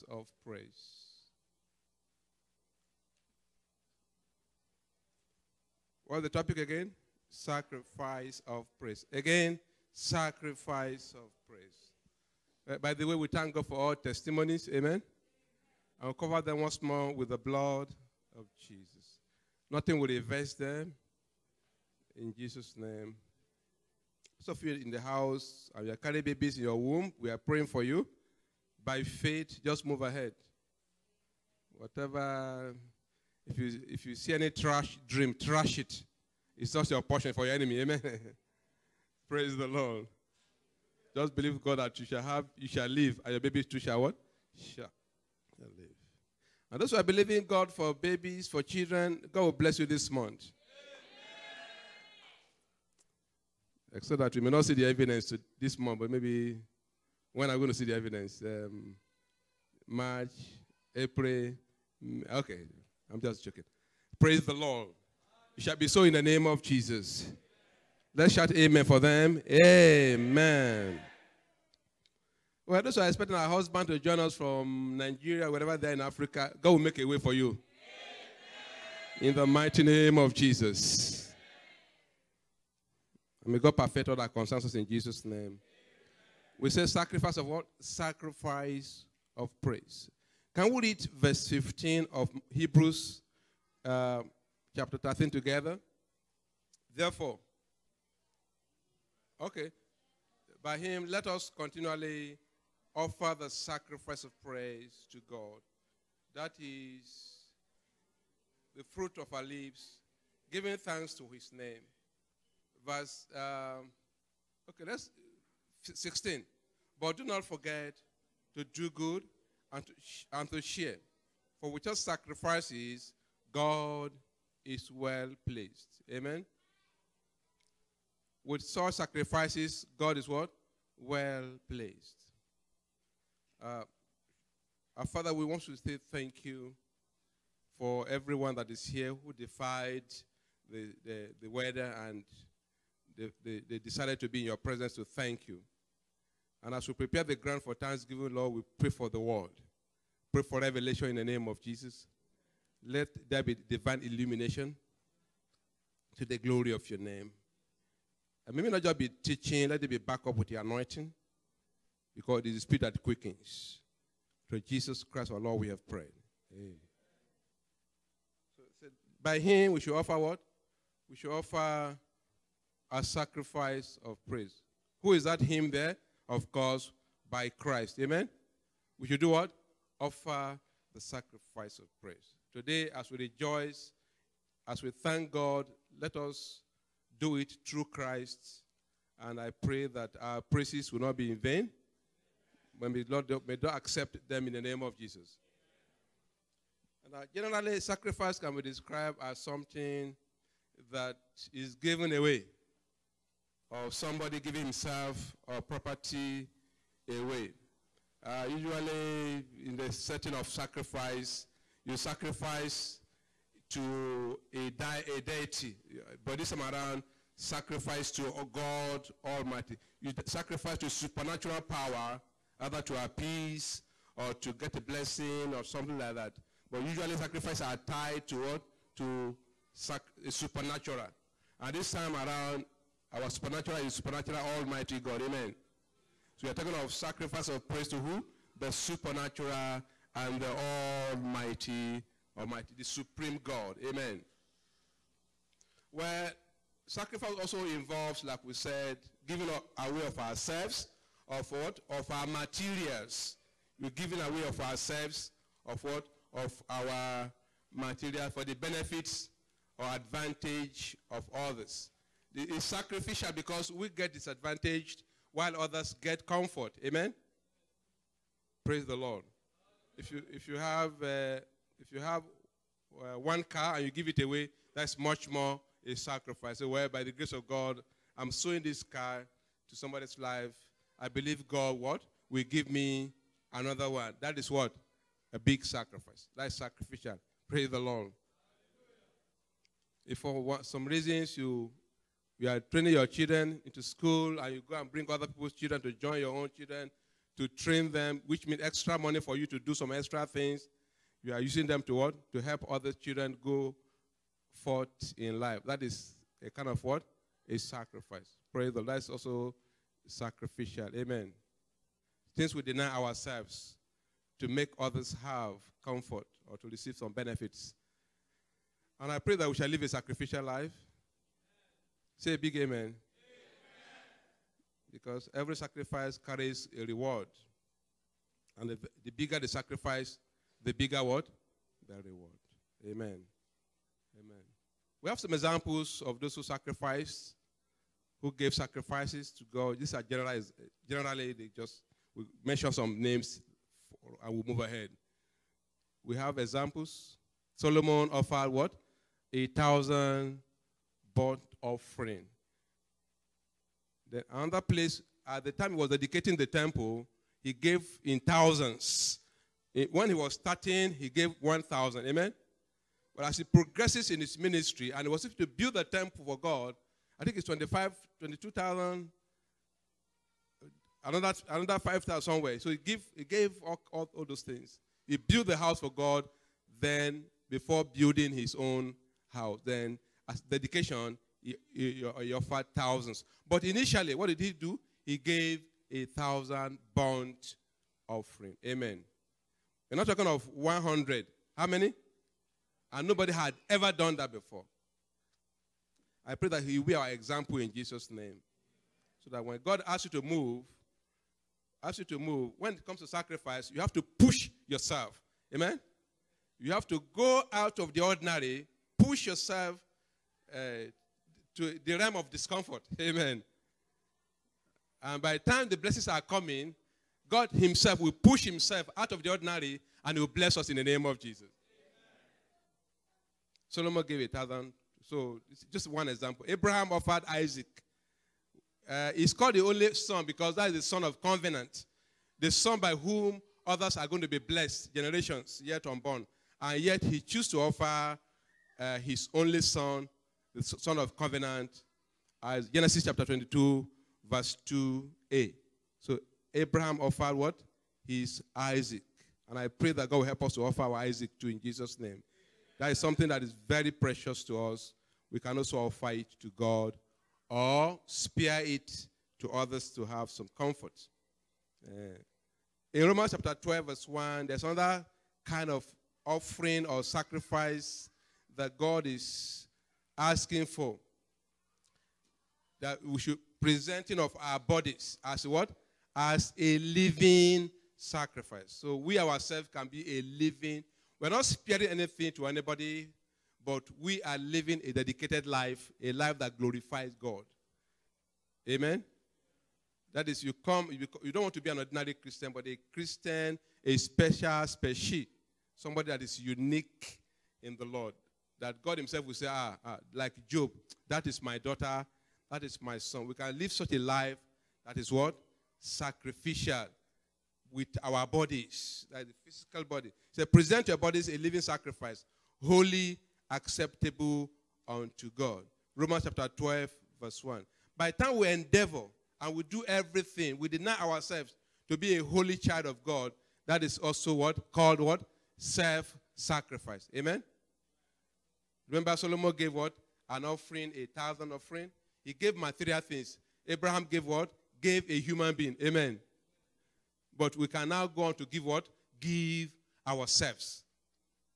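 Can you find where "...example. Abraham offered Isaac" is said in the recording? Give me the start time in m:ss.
7:06.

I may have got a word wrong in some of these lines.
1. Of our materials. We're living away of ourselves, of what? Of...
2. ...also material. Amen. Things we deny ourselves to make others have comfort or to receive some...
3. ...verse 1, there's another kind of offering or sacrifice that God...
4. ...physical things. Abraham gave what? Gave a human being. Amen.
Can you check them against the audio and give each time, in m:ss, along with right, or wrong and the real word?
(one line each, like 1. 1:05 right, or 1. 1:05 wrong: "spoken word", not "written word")
1. 4:11 wrong: "giving", not "living"
2. 5:09 wrong: "sacrificial", not "material"
3. 7:43 right
4. 8:52 wrong: "material", not "physical".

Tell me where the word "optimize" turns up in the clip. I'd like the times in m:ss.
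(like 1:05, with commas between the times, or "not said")
not said.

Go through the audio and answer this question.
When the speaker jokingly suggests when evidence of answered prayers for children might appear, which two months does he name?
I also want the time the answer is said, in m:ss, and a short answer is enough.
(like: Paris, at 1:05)
March, April, at 0:59.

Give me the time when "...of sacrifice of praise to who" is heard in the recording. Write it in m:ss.
3:56.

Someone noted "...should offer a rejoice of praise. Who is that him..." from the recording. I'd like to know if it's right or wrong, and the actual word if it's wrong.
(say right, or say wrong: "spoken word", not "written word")
wrong: "sacrifice", not "rejoice".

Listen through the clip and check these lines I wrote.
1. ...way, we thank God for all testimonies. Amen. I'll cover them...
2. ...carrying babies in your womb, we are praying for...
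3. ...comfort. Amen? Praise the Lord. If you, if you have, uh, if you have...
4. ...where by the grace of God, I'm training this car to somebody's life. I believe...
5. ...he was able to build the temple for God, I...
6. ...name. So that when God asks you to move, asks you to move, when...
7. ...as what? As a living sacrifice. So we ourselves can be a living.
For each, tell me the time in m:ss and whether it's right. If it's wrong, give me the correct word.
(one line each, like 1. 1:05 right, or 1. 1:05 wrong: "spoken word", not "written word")
1. 0:13 right
2. 0:25 right
3. 4:26 right
4. 4:36 wrong: "sowing", not "training"
5. 6:05 right
6. 6:38 right
7. 7:55 right.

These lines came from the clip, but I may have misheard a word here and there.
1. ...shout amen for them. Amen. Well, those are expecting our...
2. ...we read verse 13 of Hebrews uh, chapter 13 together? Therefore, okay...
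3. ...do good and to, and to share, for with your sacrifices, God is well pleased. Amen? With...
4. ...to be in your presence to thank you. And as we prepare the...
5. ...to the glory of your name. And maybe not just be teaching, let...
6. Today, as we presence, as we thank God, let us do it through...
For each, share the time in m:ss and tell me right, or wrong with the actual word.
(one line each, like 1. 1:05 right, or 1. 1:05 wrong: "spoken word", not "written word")
1. 1:08 right
2. 1:30 wrong: "15", not "13"
3. 1:58 right
4. 2:24 right
5. 2:36 right
6. 3:02 wrong: "rejoice", not "presence".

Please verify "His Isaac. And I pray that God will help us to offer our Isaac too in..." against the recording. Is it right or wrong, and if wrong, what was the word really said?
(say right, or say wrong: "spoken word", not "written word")
right.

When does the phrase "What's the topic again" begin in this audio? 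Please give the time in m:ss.
0:06.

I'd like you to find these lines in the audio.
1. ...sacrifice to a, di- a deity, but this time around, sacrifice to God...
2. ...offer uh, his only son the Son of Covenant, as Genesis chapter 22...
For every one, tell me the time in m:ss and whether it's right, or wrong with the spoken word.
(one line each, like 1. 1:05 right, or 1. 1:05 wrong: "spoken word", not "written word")
1. 3:31 right
2. 7:17 right.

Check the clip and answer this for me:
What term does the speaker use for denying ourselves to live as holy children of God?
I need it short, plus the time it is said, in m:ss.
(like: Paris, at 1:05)
Self-sacrifice, at 8:45.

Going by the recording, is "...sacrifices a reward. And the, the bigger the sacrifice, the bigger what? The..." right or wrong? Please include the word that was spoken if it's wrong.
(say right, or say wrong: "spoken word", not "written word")
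wrong: "carries", not "sacrifices".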